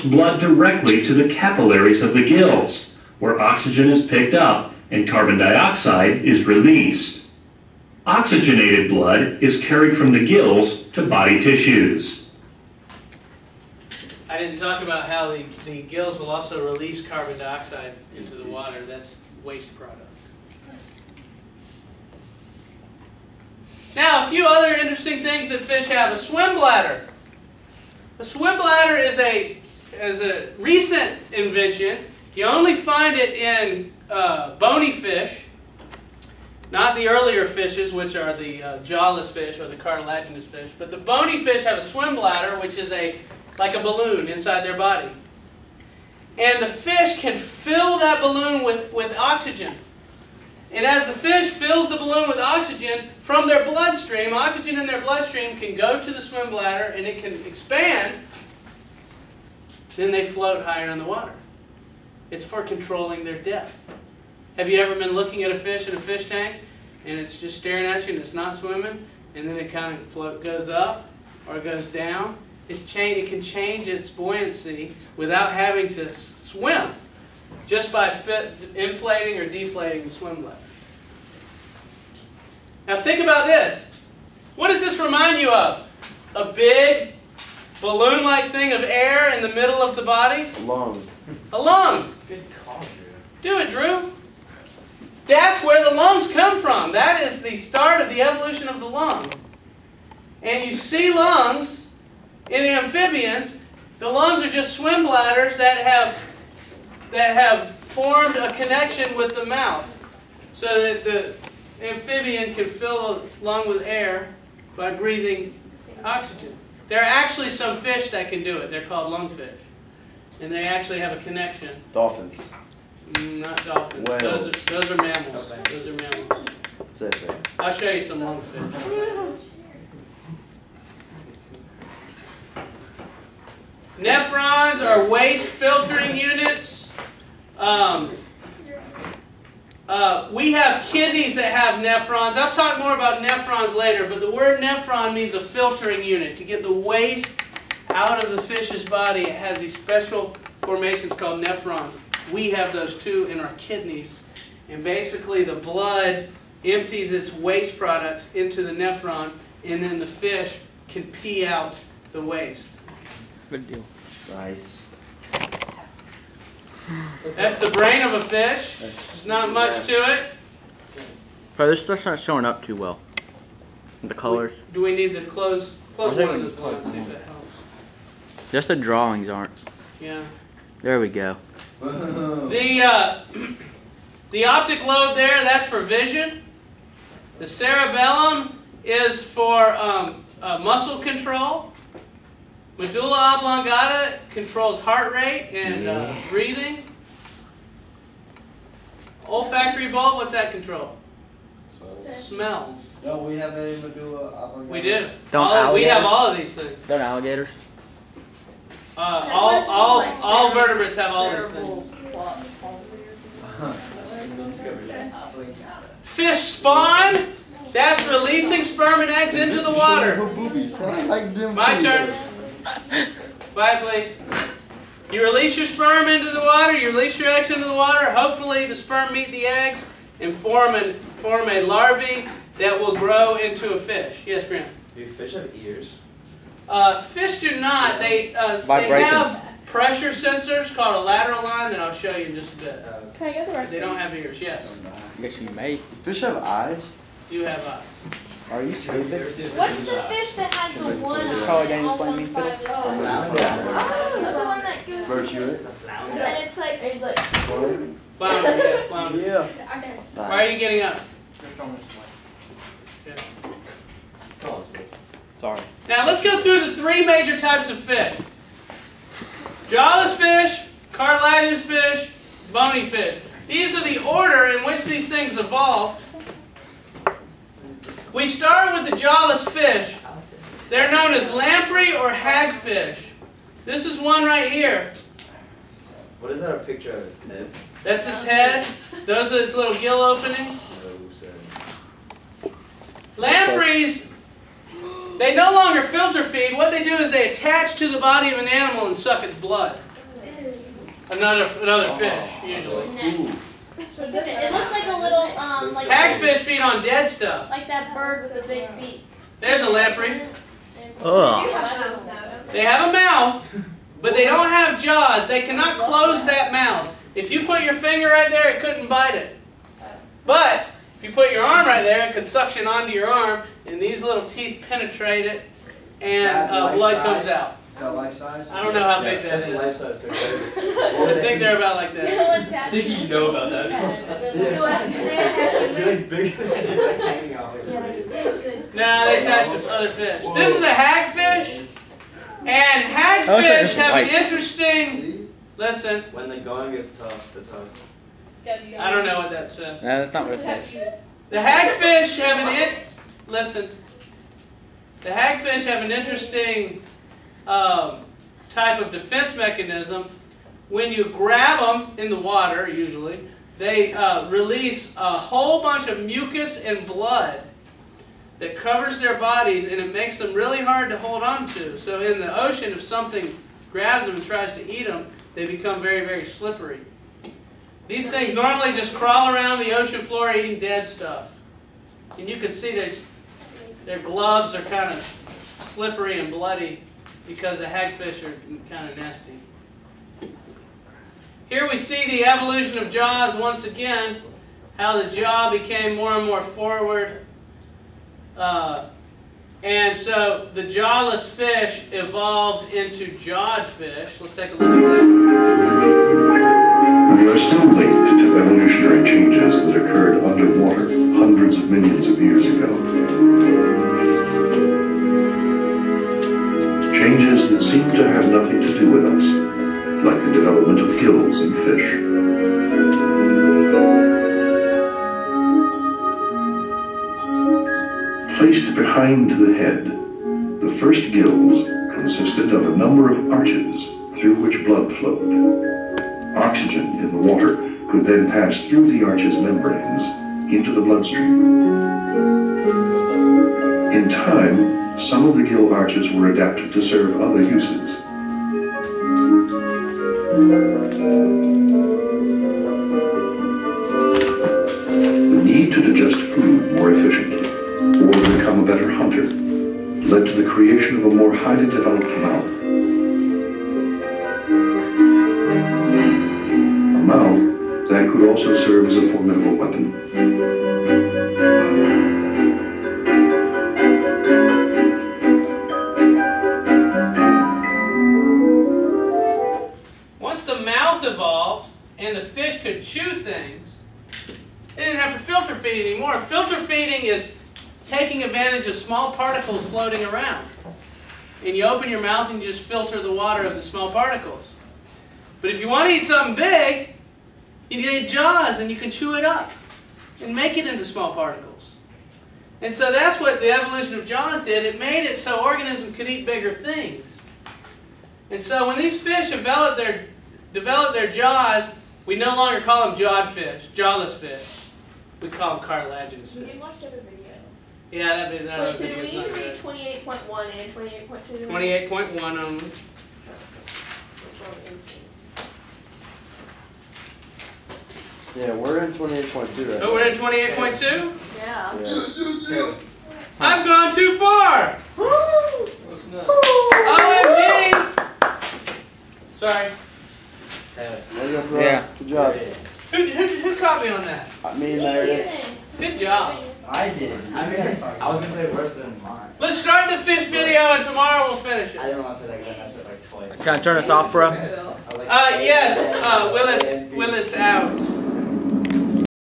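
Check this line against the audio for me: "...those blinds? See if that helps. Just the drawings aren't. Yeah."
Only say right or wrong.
right.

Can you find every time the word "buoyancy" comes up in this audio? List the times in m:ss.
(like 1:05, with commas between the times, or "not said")
1:14.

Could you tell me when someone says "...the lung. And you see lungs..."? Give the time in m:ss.
1:38.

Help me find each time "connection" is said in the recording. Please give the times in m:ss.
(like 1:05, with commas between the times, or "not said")
1:48, 2:01.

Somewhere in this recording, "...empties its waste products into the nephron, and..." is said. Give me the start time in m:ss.
2:36.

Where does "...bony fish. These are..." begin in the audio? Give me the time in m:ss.
4:32.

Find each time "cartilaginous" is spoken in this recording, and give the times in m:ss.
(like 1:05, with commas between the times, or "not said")
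0:39, 4:30, 8:35.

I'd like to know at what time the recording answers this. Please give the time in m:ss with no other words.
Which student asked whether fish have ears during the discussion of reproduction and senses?
3:54.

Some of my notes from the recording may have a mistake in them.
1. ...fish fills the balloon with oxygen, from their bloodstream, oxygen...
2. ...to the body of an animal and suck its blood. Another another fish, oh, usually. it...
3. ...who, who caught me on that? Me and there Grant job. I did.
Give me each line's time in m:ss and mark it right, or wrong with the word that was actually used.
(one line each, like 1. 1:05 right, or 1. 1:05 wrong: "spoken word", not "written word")
1. 0:51 right
2. 4:57 right
3. 9:03 wrong: "Good", not "Grant".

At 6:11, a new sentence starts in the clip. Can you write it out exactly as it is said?
So in the ocean, if something grabs them and tries to eat them, they become very, very slippery.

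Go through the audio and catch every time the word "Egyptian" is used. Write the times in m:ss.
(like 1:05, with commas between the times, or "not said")
not said.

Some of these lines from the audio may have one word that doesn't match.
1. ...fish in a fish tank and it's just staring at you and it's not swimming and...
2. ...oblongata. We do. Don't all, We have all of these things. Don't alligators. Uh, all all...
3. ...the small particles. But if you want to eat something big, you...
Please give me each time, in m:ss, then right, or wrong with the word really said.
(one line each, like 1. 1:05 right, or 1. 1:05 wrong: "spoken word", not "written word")
1. 1:05 right
2. 3:24 right
3. 8:13 right.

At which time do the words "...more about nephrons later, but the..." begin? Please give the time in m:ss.
2:22.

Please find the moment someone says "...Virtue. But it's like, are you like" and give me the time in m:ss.
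4:14.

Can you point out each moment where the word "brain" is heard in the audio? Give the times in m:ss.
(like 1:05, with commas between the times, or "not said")
2:47.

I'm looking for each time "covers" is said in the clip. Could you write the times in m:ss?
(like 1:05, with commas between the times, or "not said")
6:08.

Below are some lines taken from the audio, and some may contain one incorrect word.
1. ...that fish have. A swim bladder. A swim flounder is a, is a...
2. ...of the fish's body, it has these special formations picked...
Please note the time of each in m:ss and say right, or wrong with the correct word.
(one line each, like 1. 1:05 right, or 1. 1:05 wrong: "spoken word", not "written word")
1. 0:25 wrong: "bladder", not "flounder"
2. 2:28 wrong: "called", not "picked".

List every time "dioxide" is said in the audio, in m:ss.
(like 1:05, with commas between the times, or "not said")
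0:05, 0:17.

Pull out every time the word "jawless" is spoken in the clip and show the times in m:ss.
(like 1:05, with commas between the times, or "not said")
0:38, 4:29, 4:38, 6:40, 8:33.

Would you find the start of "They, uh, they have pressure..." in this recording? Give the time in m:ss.
3:57.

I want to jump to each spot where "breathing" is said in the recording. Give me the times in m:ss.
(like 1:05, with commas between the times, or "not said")
1:54, 3:16.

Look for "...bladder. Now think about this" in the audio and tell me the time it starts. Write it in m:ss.
1:20.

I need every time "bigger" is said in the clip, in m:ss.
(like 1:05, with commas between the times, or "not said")
8:26.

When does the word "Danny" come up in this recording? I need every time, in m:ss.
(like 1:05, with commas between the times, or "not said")
4:11.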